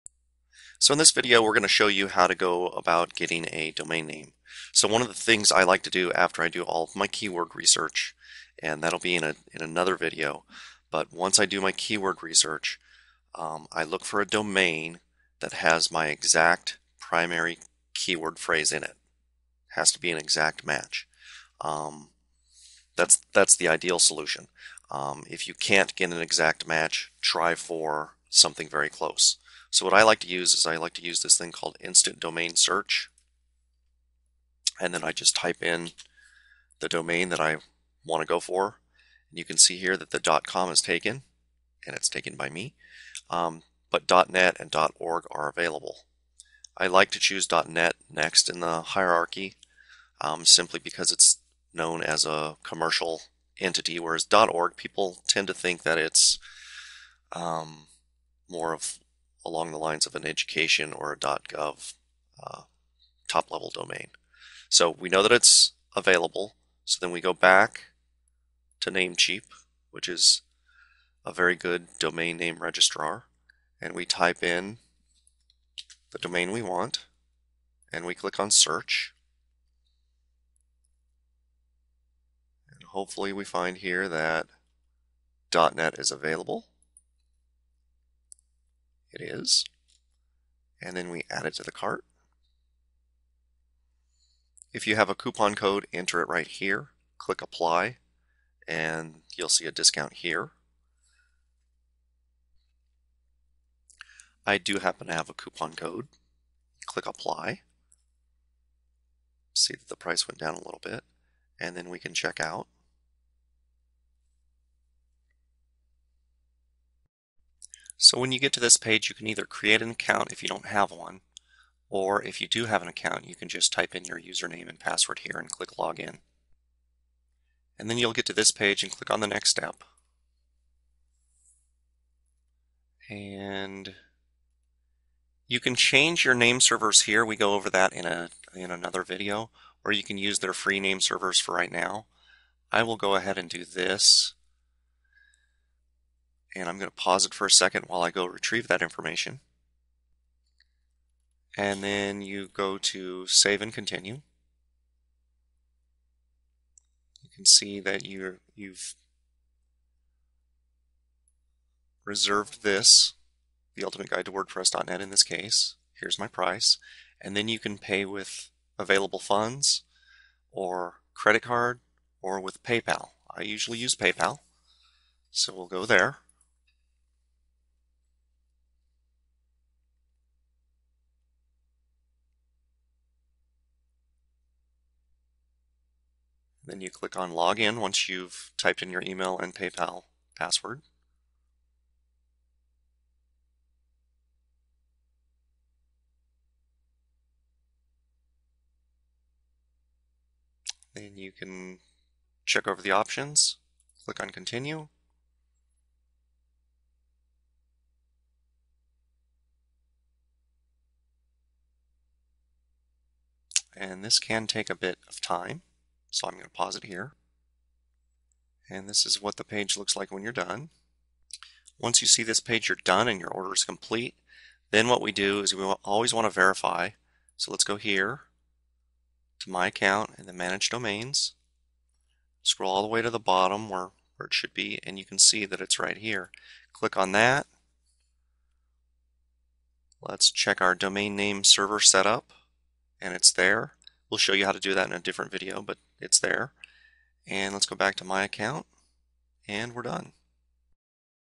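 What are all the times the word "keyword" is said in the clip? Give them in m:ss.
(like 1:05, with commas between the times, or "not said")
0:07, 0:11, 0:17.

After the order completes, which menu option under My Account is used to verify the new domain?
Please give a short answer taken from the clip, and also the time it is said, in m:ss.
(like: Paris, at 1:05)
Manage Domains, at 3:50.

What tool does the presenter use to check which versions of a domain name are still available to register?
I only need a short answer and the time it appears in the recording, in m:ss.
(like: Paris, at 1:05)
Instant Domain Search, at 0:31.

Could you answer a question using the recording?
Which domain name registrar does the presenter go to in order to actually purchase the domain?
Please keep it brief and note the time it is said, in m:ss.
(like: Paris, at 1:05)
Namecheap, at 1:08.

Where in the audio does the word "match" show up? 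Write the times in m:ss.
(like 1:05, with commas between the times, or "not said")
0:20, 0:26.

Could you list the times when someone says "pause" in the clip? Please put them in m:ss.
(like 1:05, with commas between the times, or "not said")
2:26, 3:36.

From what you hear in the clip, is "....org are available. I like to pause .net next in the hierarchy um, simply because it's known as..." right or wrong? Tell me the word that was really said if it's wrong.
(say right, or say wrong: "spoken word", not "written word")
wrong: "choose", not "pause".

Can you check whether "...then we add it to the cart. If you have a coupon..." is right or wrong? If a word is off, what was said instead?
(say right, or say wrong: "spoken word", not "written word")
right.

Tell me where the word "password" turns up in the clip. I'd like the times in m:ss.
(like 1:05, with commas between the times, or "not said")
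2:04, 3:10.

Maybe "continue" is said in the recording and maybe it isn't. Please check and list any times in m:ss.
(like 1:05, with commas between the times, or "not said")
2:33, 3:24.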